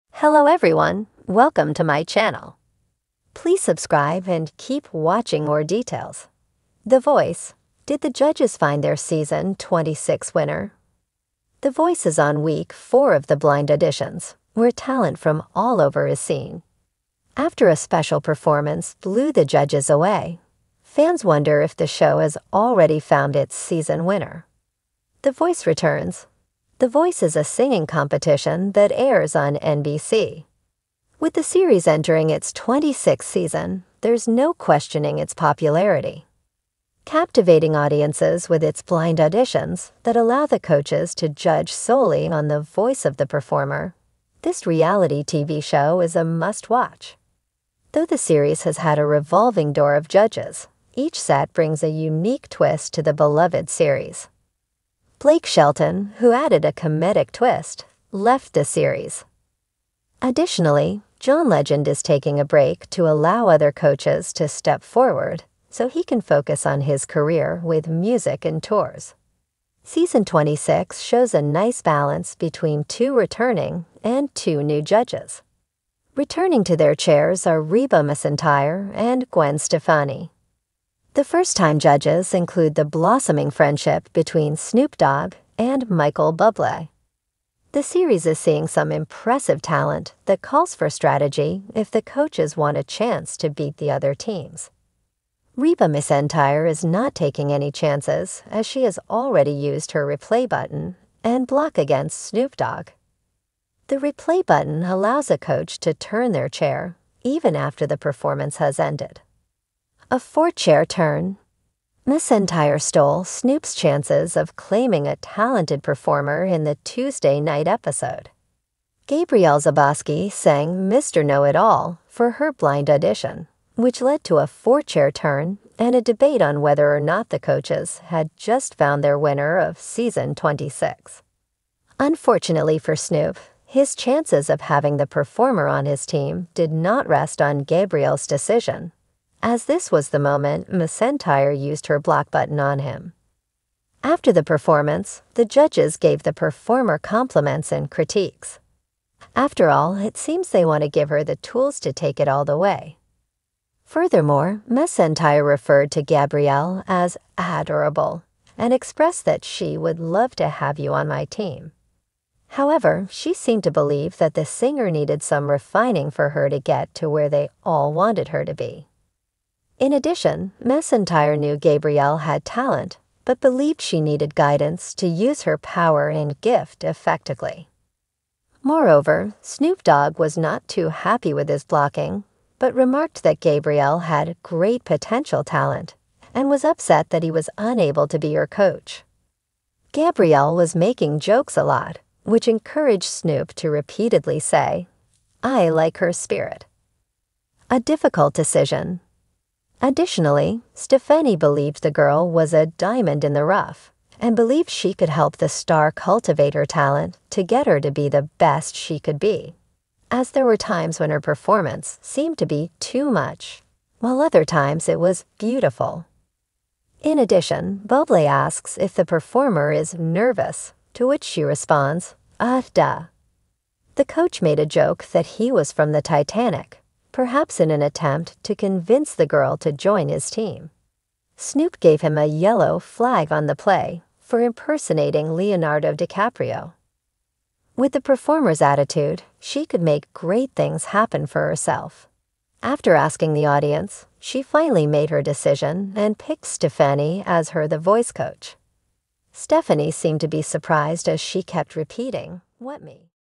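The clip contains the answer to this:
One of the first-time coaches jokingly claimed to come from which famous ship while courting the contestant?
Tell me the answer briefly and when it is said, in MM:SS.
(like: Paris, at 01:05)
Titanic, at 03:46.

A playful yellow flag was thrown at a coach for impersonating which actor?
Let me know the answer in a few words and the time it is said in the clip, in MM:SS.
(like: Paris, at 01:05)
Leonardo DiCaprio, at 03:55.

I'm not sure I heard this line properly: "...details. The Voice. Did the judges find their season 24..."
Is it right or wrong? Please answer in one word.
wrong.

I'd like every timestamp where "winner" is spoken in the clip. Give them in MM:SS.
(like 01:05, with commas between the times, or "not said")
00:10, 00:24, 02:09.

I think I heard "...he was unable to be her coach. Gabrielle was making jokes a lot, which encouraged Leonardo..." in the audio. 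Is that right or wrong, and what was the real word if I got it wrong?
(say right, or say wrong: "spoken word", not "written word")
wrong: "Snoop", not "Leonardo".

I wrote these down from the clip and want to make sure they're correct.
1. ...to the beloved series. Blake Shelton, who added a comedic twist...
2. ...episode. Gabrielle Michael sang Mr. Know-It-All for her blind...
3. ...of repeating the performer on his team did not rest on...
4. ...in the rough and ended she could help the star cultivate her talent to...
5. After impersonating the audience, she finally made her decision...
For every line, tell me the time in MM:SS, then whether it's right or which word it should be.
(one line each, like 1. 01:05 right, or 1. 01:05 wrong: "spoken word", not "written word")
1. 00:52 right
2. 01:57 wrong: "Zabosky", not "Michael"
3. 02:14 wrong: "having", not "repeating"
4. 03:23 wrong: "believed", not "ended"
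5. 04:02 wrong: "asking", not "impersonating".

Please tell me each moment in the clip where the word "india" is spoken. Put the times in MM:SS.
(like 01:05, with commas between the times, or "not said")
not said.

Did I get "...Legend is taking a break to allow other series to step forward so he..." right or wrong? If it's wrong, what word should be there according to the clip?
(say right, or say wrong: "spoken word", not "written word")
wrong: "coaches", not "series".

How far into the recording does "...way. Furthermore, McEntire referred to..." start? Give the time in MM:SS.
02:32.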